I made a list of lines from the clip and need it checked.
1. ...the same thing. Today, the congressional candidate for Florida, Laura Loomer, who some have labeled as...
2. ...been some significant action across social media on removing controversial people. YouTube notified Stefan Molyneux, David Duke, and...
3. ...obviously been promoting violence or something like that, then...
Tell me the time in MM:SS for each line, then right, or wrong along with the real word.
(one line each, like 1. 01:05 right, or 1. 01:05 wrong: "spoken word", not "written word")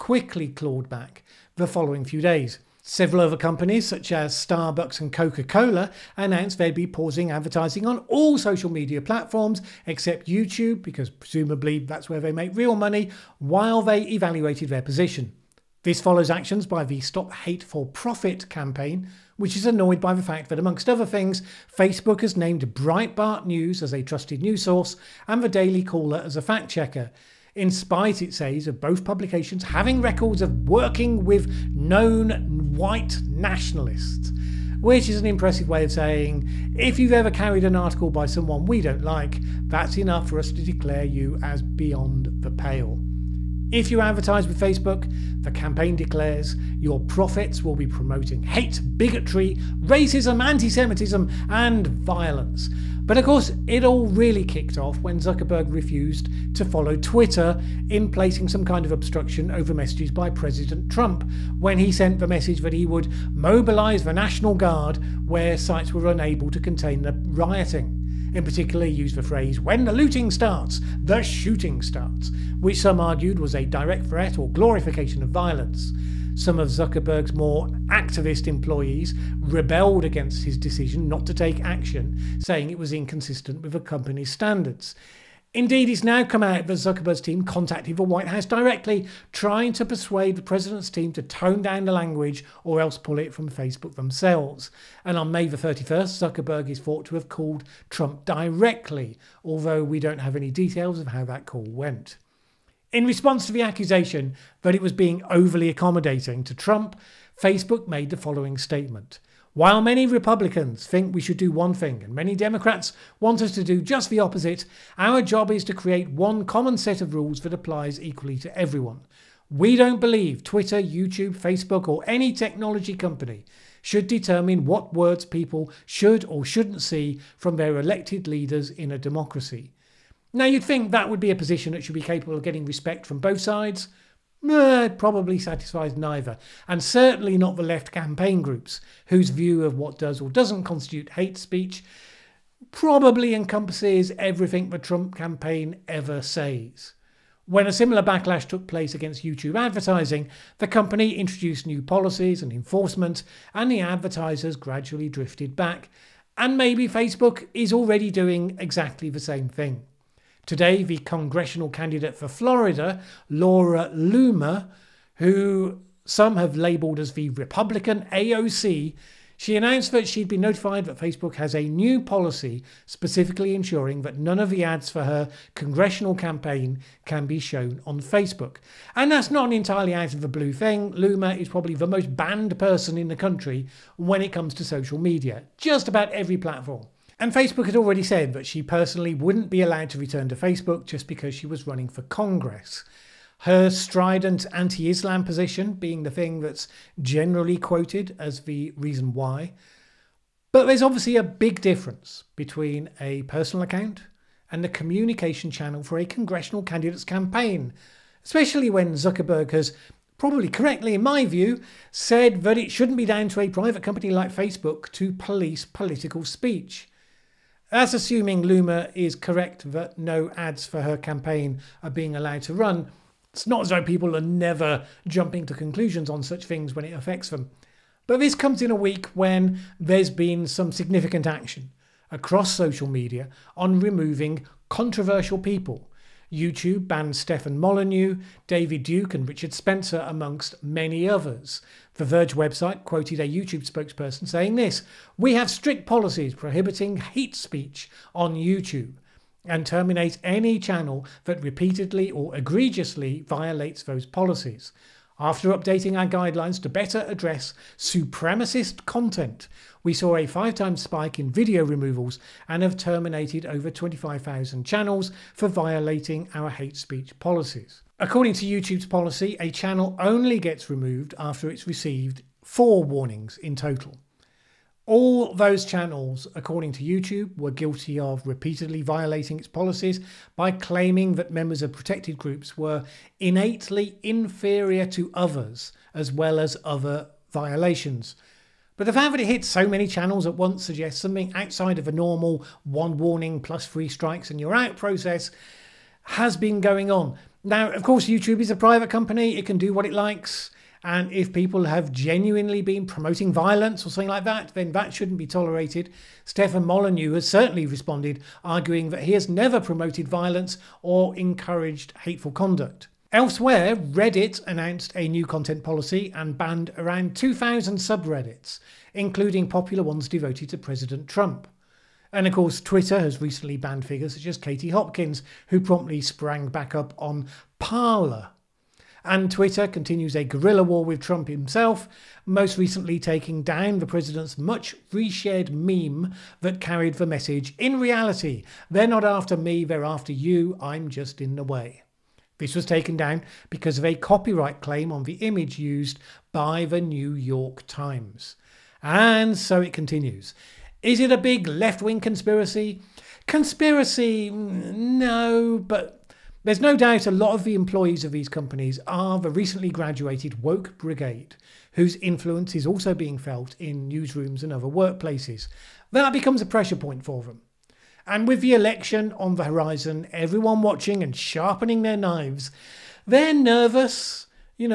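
1. 02:39 right
2. 03:50 wrong: "banned", not "notified"
3. 05:01 wrong: "genuinely", not "obviously".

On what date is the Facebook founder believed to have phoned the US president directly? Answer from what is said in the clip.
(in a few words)
May 31st.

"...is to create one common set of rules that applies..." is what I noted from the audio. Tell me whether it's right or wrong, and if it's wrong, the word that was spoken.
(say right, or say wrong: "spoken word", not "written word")
right.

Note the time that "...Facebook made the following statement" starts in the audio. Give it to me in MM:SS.
01:47.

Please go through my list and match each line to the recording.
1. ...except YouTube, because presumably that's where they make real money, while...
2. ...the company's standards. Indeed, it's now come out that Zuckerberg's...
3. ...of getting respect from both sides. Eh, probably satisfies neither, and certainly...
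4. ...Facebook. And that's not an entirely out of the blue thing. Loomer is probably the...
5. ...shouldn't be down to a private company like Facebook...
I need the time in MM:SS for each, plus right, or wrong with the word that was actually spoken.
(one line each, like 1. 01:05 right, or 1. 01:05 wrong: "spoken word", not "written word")
1. 00:09 right
2. 01:23 right
3. 02:12 right
4. 02:57 right
5. 03:32 right.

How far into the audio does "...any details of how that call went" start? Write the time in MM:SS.
01:40.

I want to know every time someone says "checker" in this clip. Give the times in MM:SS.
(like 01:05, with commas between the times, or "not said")
00:26.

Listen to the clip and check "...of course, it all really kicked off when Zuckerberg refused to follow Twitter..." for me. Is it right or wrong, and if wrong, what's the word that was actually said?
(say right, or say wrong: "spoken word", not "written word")
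right.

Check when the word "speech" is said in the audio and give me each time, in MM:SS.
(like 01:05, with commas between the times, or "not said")
02:21, 03:36, 04:07, 04:26.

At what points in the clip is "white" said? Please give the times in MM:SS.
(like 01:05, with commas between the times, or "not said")
00:32, 01:28.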